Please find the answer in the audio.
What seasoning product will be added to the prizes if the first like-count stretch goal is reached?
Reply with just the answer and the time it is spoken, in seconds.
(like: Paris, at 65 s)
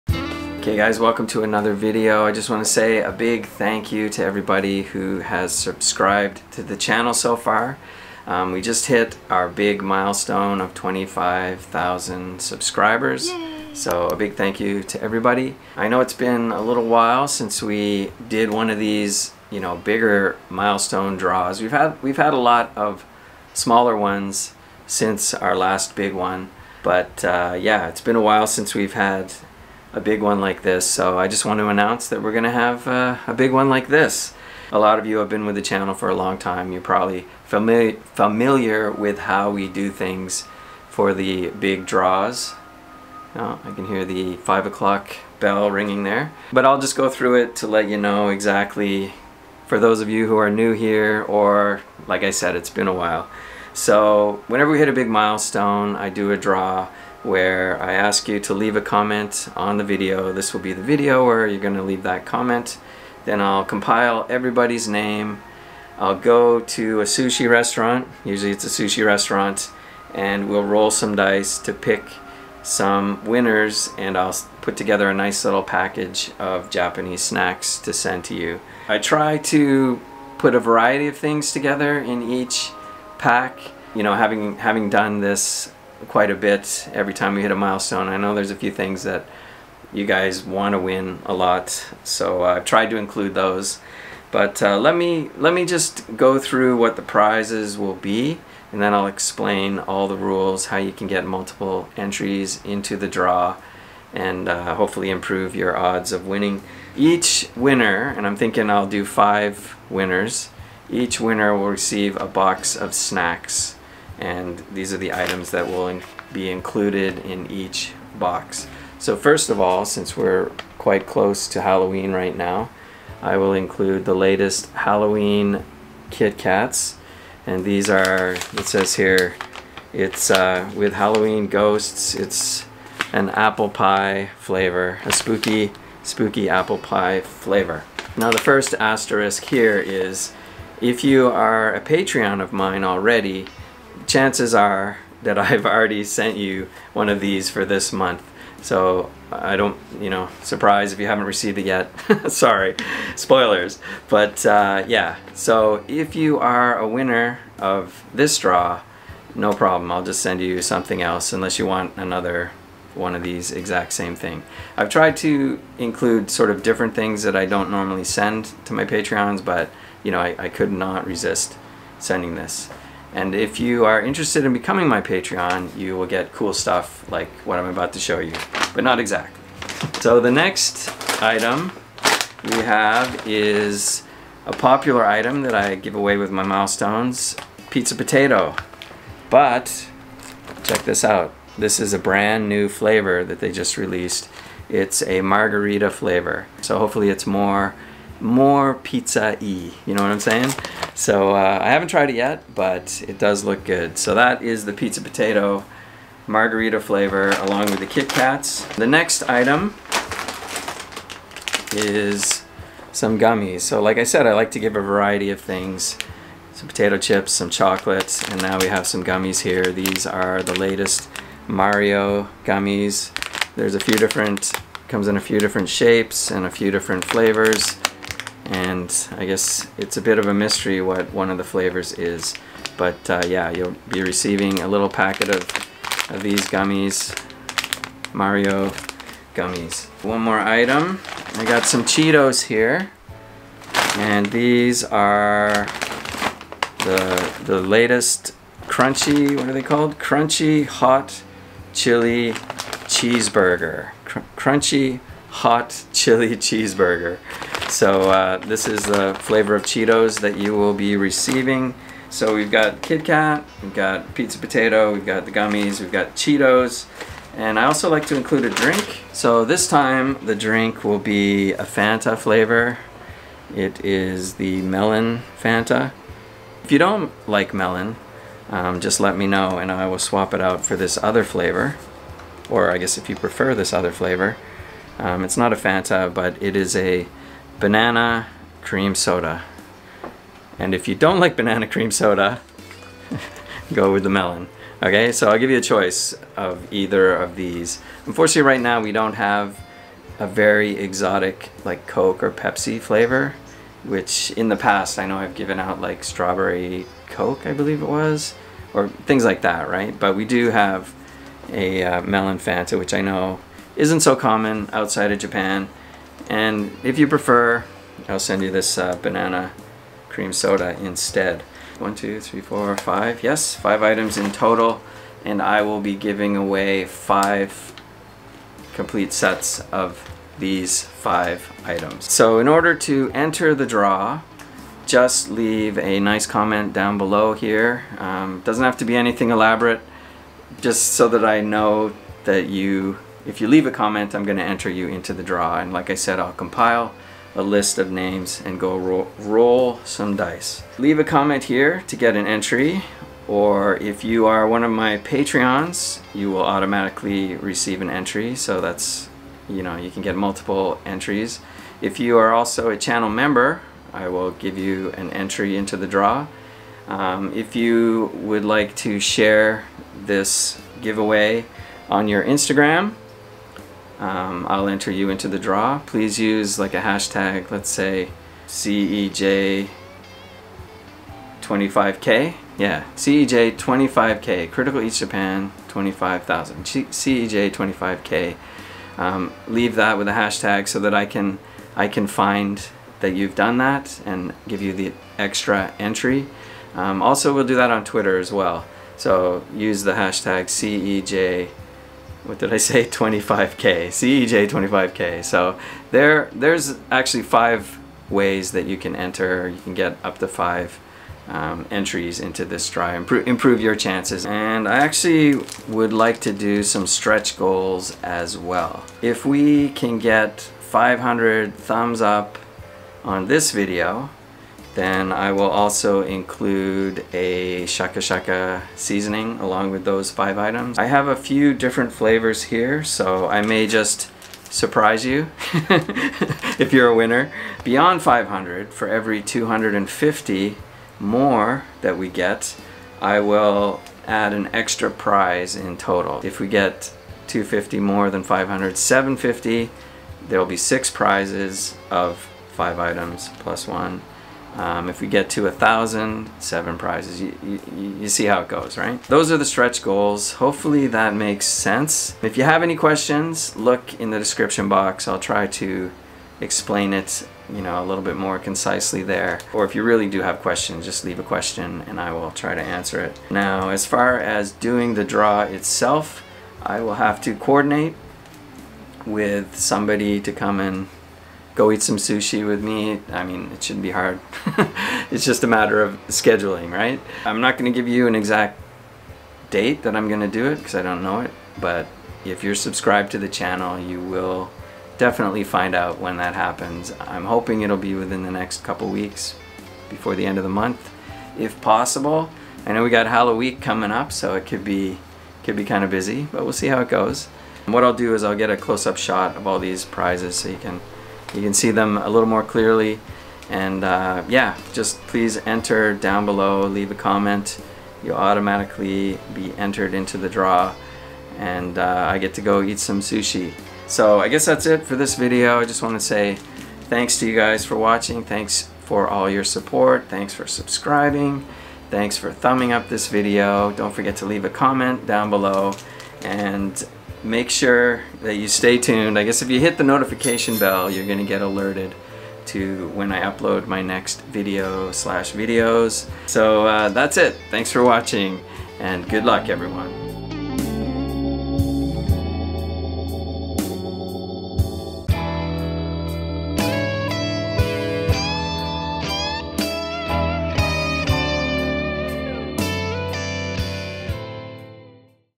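shaka shaka seasoning, at 427 s.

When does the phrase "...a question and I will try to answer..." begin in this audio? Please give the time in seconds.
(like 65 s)
471 s.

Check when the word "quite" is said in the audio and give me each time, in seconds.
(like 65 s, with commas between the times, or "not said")
86 s, 120 s.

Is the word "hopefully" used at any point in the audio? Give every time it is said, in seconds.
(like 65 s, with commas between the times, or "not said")
104 s, 196 s, 460 s.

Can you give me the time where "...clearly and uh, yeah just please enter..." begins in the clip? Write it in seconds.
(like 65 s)
512 s.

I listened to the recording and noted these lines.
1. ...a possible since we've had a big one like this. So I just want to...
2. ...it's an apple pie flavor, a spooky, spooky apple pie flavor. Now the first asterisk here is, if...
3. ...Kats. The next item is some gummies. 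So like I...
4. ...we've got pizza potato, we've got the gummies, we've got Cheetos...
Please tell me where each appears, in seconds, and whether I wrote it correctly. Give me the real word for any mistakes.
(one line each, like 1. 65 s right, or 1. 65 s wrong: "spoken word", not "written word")
1. 28 s wrong: "while", not "possible"
2. 132 s right
3. 208 s right
4. 263 s right.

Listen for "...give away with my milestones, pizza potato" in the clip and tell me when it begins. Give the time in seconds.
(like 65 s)
185 s.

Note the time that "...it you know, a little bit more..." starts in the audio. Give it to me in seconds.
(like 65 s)
466 s.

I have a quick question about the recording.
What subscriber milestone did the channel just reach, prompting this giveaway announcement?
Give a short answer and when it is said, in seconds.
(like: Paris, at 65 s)
25,000, at 10 s.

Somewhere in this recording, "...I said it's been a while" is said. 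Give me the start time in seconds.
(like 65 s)
52 s.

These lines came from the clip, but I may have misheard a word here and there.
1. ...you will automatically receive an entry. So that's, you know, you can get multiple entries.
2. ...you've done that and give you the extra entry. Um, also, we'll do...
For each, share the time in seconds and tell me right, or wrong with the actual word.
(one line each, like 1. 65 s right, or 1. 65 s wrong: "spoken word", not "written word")
1. 356 s right
2. 393 s right.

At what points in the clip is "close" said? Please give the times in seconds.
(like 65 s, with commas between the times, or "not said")
121 s, 508 s.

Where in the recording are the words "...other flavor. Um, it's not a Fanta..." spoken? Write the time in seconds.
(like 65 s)
283 s.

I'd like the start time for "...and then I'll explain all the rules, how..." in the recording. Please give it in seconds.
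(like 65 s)
98 s.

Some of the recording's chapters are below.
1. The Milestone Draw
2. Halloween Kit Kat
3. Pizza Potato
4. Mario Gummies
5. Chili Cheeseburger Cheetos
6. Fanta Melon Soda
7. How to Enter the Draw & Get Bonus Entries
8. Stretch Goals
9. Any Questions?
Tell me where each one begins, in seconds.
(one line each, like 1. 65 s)
1. 46 s
2. 107 s
3. 180 s
4. 209 s
5. 240 s
6. 267 s
7. 332 s
8. 414 s
9. 462 s.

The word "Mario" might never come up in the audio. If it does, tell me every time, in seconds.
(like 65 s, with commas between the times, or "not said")
221 s, 238 s.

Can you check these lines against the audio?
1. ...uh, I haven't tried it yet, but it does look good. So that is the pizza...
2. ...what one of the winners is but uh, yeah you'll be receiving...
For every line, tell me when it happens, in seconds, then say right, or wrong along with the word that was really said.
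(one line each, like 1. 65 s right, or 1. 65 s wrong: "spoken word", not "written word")
1. 201 s right
2. 230 s wrong: "flavors", not "winners".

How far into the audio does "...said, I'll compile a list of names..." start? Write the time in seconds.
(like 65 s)
345 s.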